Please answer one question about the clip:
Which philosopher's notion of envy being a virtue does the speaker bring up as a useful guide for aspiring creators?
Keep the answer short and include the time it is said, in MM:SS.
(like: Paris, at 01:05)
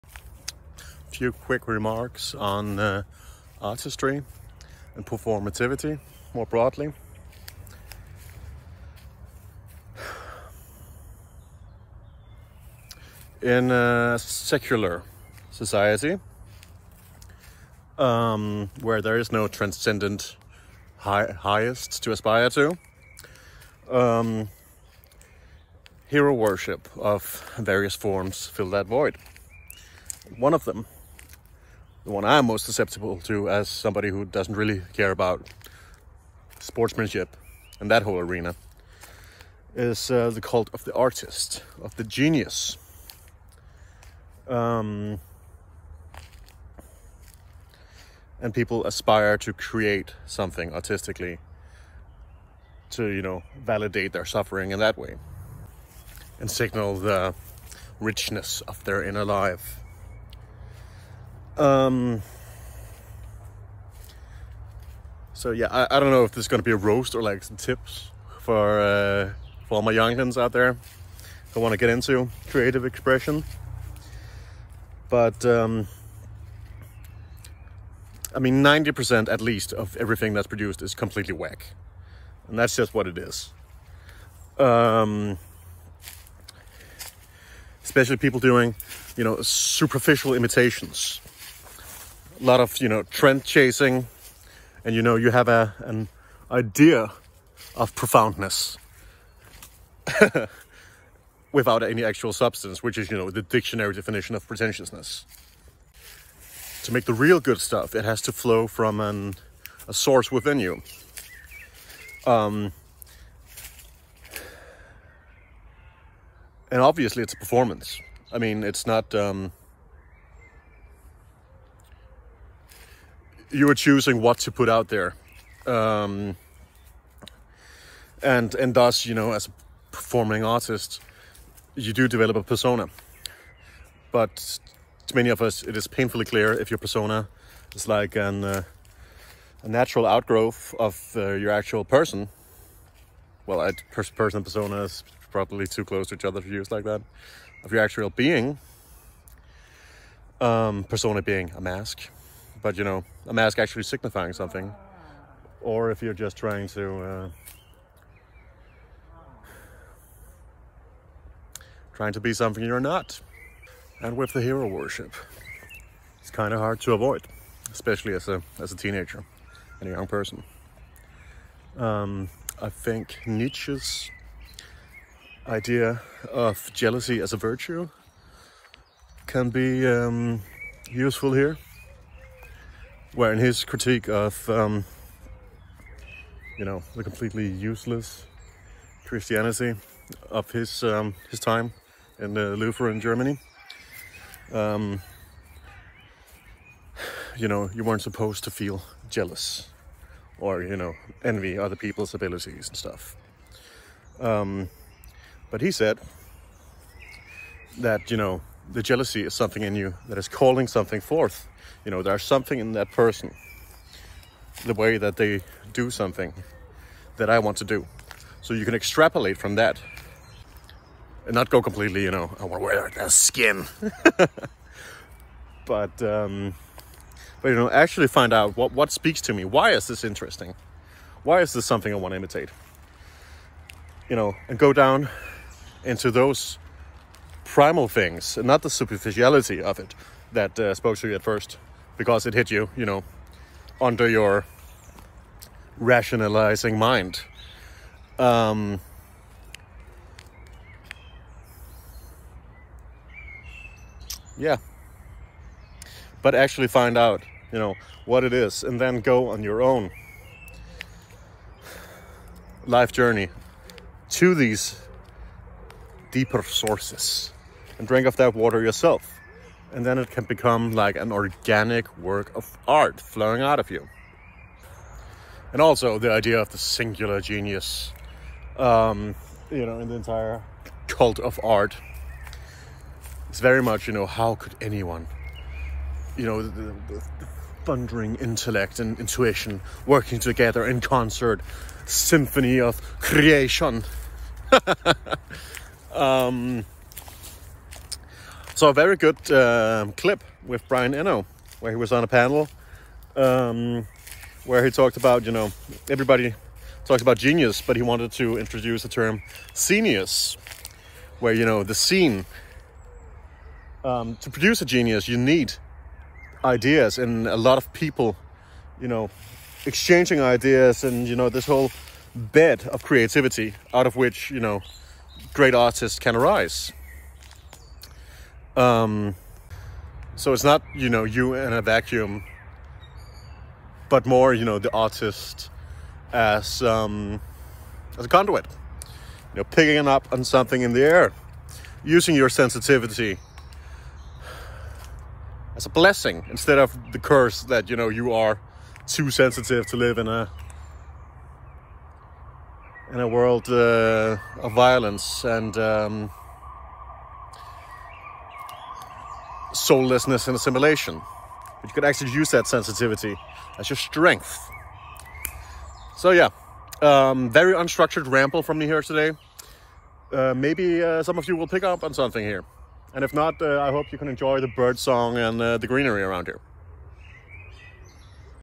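Nietzsche, at 02:53.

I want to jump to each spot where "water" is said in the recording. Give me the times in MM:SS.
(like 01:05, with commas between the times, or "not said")
04:28.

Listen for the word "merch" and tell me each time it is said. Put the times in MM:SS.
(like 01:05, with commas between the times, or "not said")
not said.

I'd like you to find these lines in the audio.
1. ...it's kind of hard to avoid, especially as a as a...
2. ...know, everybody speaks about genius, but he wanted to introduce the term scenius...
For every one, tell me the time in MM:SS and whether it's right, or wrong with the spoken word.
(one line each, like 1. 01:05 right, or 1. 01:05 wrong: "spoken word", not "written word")
1. 02:46 right
2. 05:05 wrong: "talks", not "speaks".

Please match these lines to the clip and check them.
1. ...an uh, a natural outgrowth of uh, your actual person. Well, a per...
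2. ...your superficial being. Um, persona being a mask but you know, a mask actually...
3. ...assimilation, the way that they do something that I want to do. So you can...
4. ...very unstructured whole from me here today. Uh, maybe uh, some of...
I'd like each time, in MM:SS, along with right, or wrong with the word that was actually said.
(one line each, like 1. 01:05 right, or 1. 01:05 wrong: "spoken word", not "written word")
1. 02:18 right
2. 02:27 wrong: "actual", not "superficial"
3. 03:32 wrong: "person", not "assimilation"
4. 06:07 wrong: "ramble", not "whole".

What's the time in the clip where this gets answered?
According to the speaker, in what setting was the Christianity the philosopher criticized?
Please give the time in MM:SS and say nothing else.
03:12.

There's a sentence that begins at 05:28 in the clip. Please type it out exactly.
Um, so it's not, you know, you in a vacuum, but more, you know, the artist as, um, as a conduit.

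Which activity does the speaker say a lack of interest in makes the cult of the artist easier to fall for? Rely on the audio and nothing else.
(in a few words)
sportsmanship.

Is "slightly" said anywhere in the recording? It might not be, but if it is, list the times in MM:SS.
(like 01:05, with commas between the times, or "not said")
not said.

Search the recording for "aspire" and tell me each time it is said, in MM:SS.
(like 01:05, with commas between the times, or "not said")
00:22, 00:48.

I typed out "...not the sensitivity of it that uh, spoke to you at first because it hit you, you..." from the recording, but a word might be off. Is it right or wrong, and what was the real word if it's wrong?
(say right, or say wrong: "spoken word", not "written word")
wrong: "superficiality", not "sensitivity".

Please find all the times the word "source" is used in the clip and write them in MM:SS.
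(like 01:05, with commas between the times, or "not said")
01:49, 04:26.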